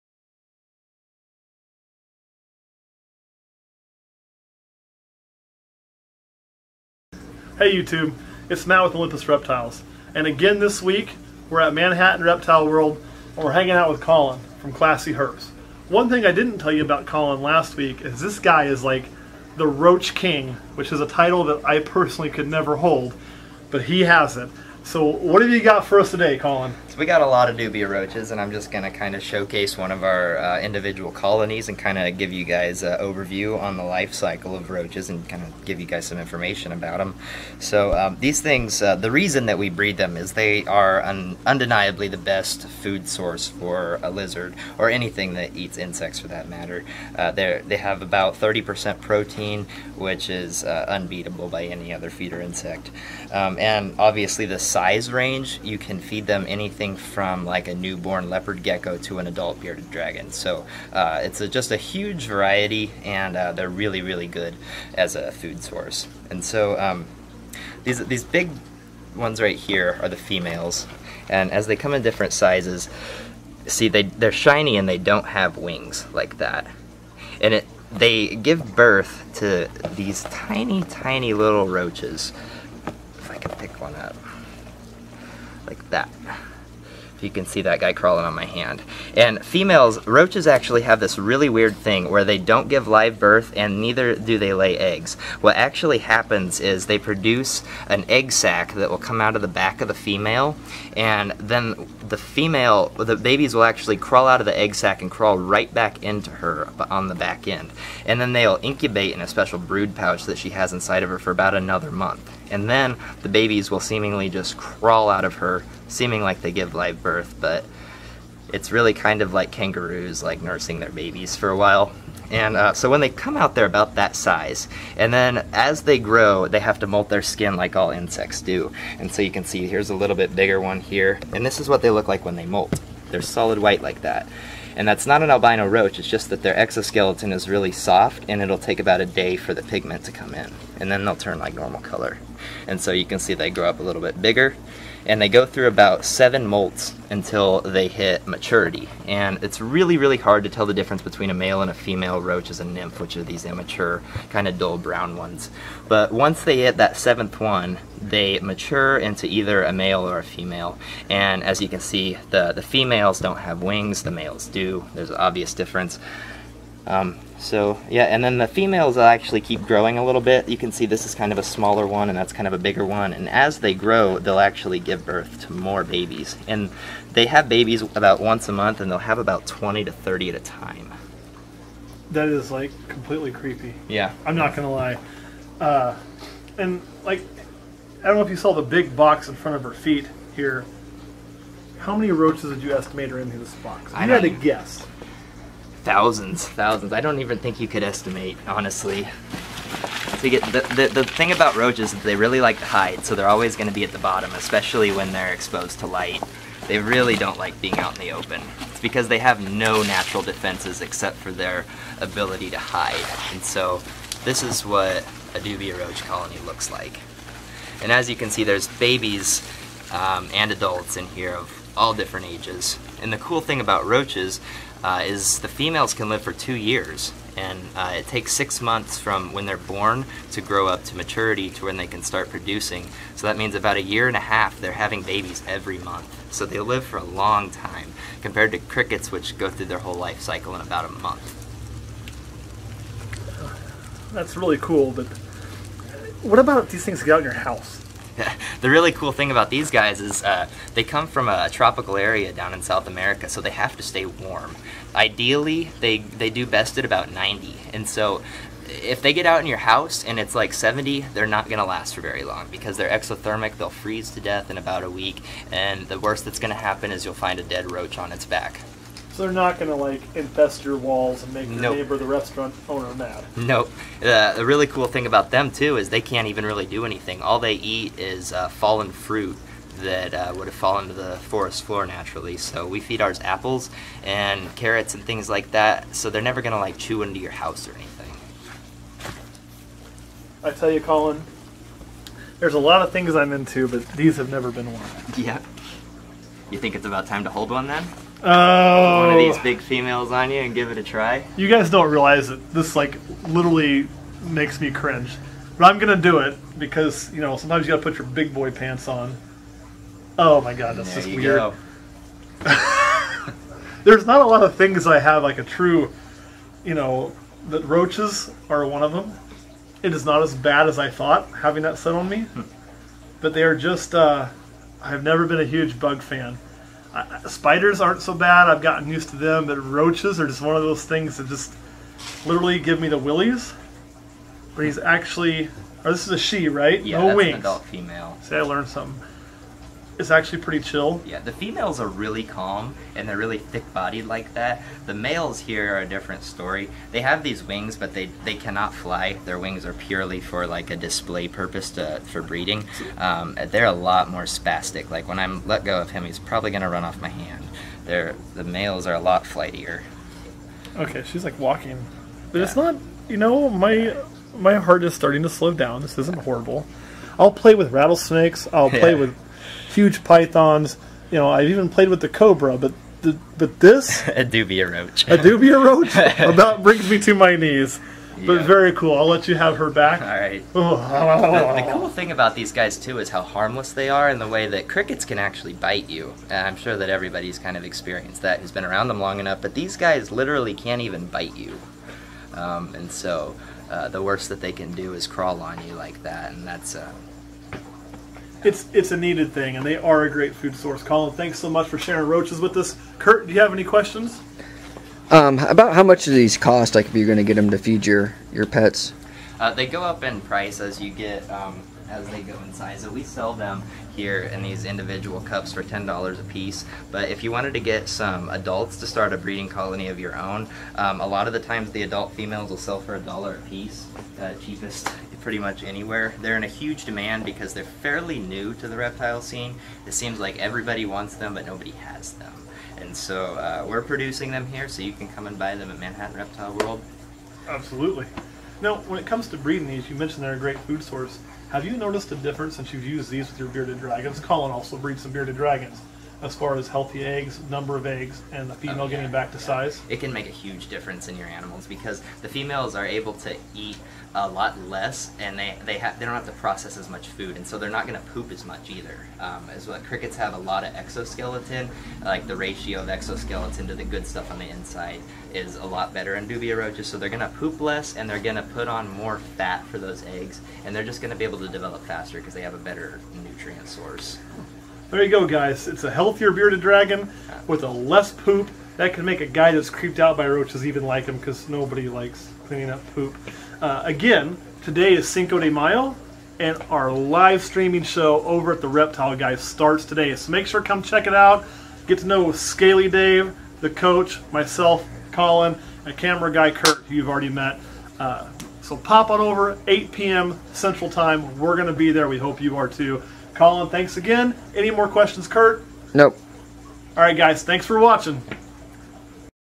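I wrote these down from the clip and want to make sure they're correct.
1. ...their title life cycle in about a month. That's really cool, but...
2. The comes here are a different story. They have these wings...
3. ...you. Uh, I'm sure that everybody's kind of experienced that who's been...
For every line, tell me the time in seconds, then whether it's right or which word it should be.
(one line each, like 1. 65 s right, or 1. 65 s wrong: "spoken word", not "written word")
1. 239 s wrong: "whole", not "title"
2. 344 s wrong: "males", not "comes"
3. 385 s right.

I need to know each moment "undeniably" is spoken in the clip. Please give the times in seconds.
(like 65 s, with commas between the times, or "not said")
41 s.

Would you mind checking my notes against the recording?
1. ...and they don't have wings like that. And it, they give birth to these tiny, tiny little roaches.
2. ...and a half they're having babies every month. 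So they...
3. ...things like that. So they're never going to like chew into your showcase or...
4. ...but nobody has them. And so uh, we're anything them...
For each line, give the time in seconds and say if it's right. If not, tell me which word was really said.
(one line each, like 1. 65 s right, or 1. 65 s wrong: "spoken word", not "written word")
1. 74 s right
2. 234 s right
3. 285 s wrong: "house", not "showcase"
4. 431 s wrong: "producing", not "anything".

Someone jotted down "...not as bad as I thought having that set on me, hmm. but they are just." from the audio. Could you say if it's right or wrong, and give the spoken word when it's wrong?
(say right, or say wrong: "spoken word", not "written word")
right.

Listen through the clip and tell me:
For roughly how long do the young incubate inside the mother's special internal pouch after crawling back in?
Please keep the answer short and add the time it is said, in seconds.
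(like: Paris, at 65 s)
about a month, at 111 s.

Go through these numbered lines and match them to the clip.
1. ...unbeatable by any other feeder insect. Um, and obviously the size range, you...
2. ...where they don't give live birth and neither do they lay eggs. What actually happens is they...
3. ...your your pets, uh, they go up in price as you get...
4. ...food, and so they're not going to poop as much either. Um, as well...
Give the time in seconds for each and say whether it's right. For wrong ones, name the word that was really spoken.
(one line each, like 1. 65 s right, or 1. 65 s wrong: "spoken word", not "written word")
1. 50 s right
2. 92 s right
3. 407 s right
4. 457 s right.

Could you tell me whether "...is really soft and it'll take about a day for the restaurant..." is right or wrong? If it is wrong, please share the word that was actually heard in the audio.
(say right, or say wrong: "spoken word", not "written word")
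wrong: "pigment", not "restaurant".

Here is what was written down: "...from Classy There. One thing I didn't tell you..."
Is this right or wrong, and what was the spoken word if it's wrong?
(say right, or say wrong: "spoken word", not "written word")
wrong: "Herps", not "There".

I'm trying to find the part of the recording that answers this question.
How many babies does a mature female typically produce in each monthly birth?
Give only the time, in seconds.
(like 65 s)
179 s.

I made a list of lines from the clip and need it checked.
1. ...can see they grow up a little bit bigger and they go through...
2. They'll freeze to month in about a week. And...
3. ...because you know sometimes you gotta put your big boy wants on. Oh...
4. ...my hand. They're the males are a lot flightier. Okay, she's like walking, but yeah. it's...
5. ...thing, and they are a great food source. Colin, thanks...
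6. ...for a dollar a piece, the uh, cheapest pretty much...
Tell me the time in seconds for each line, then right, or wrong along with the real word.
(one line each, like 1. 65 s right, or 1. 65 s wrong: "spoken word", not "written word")
1. 143 s right
2. 263 s wrong: "death", not "month"
3. 306 s wrong: "pants", not "wants"
4. 356 s right
5. 399 s right
6. 422 s right.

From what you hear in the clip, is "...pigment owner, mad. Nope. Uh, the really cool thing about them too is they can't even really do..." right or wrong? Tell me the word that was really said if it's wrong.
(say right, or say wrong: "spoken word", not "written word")
wrong: "restaurant", not "pigment".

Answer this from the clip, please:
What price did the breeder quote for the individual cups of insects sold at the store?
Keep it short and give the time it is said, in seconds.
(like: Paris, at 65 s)
$10, at 415 s.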